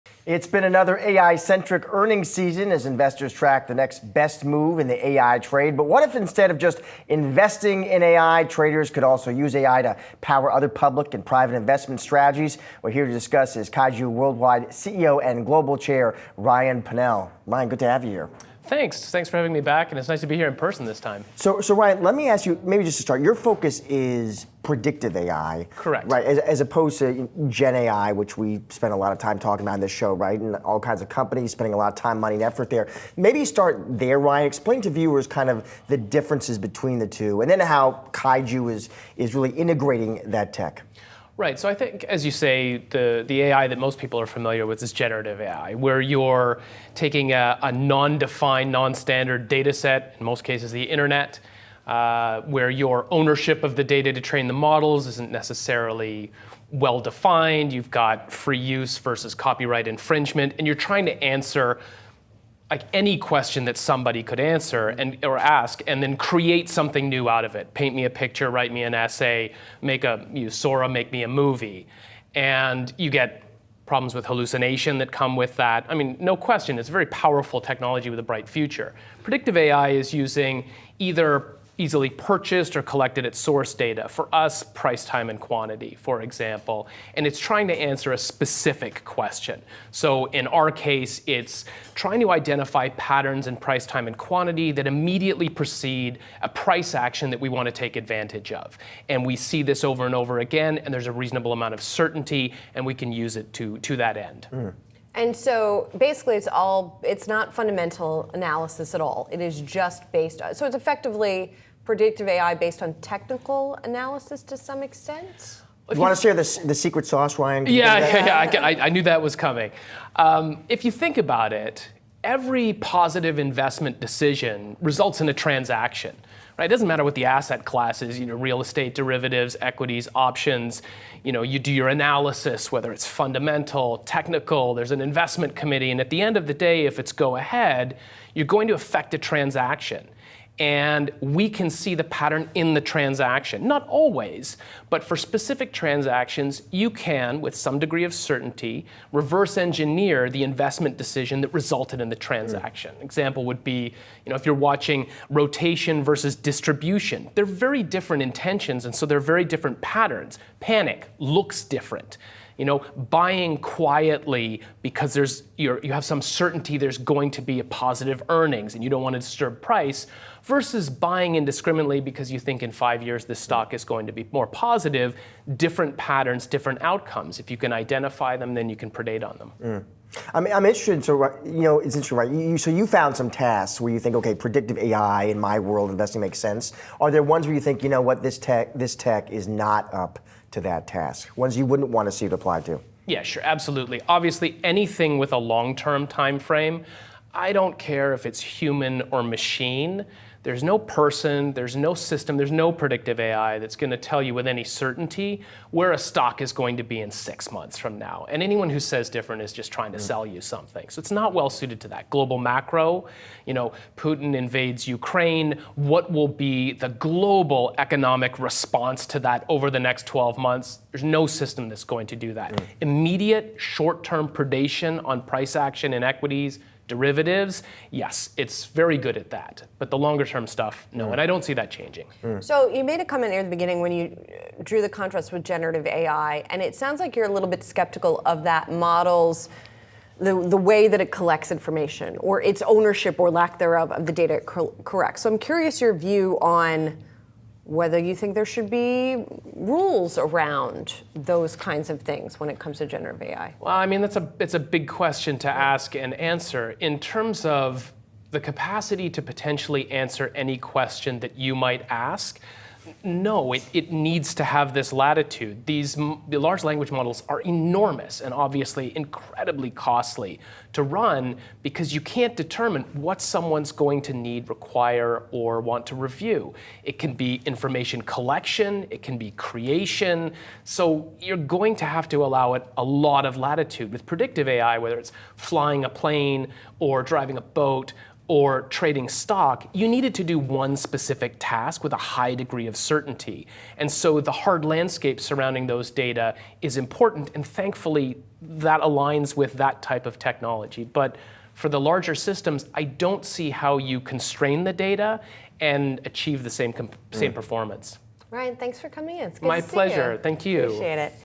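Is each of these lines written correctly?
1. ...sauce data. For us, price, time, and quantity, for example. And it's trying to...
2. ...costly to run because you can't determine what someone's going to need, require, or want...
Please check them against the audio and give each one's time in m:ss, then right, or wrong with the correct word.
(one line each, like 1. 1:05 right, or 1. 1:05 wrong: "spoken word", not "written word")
1. 1:23 wrong: "source", not "sauce"
2. 4:29 right.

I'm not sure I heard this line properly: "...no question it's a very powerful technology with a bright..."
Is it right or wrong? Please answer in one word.
right.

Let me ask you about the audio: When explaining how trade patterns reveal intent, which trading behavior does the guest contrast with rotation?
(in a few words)
distribution.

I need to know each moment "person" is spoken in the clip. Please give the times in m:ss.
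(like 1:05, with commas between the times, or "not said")
0:20, 3:20.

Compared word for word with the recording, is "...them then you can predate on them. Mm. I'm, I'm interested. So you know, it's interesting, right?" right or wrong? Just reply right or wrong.
right.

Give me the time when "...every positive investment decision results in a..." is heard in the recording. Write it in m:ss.
2:02.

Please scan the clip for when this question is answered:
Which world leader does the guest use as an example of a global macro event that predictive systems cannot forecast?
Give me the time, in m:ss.
3:33.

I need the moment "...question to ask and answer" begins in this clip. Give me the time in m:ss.
4:14.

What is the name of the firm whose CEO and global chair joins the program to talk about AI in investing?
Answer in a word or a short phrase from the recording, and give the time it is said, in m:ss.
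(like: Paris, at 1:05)
Kaiju Worldwide, at 0:13.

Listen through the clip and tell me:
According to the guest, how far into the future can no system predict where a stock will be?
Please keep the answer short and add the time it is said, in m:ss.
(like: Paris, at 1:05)
6 months, at 3:27.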